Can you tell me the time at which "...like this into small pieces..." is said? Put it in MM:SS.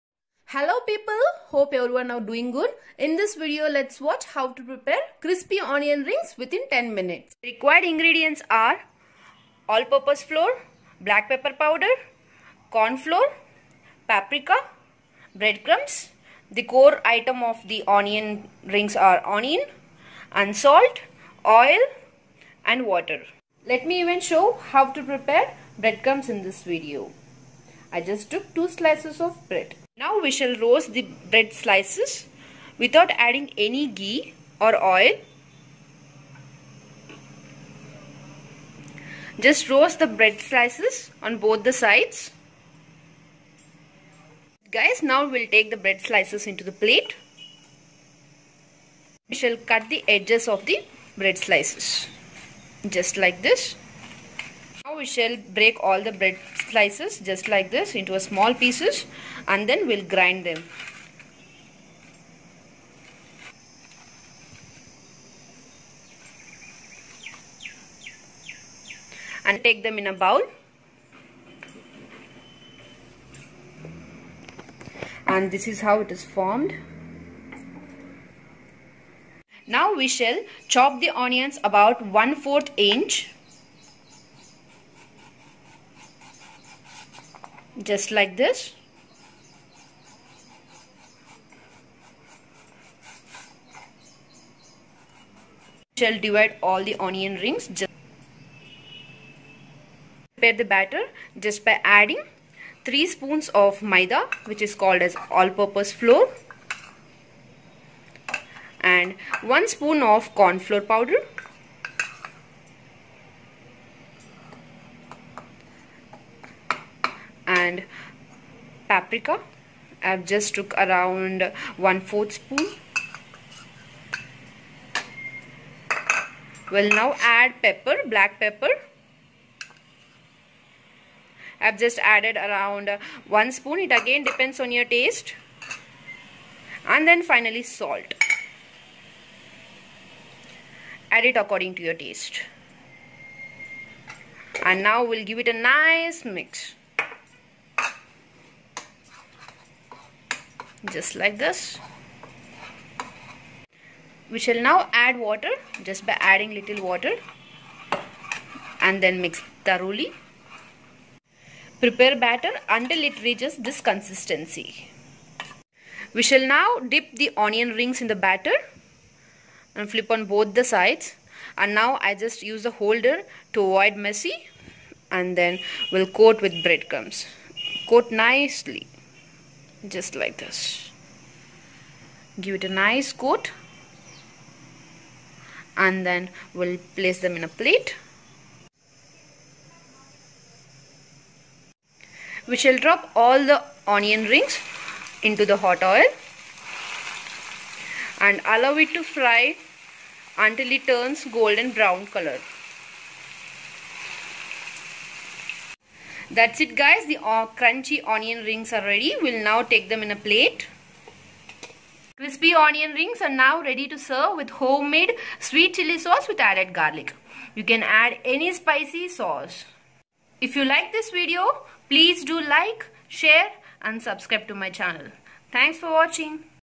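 00:57.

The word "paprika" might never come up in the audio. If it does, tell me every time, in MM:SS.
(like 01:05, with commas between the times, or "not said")
00:14, 01:58.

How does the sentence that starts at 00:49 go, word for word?
We shall cut the edges of the bread slices.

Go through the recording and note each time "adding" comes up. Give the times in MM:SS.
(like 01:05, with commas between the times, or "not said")
00:33, 01:41, 02:36.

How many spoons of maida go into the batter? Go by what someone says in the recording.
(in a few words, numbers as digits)
3.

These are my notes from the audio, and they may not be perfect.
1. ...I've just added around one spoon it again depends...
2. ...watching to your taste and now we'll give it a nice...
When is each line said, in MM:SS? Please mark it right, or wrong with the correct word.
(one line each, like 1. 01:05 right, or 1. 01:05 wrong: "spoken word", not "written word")
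1. 02:11 right
2. 02:21 wrong: "according", not "watching".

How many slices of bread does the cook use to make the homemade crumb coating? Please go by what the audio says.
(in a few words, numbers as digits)
2.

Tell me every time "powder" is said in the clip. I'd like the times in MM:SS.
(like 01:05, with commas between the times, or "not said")
00:11, 01:50.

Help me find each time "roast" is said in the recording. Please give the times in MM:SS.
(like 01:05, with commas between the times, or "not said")
00:30, 00:39.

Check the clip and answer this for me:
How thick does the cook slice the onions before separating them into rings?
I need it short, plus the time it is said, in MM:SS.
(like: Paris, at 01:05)
1/4 inch, at 01:22.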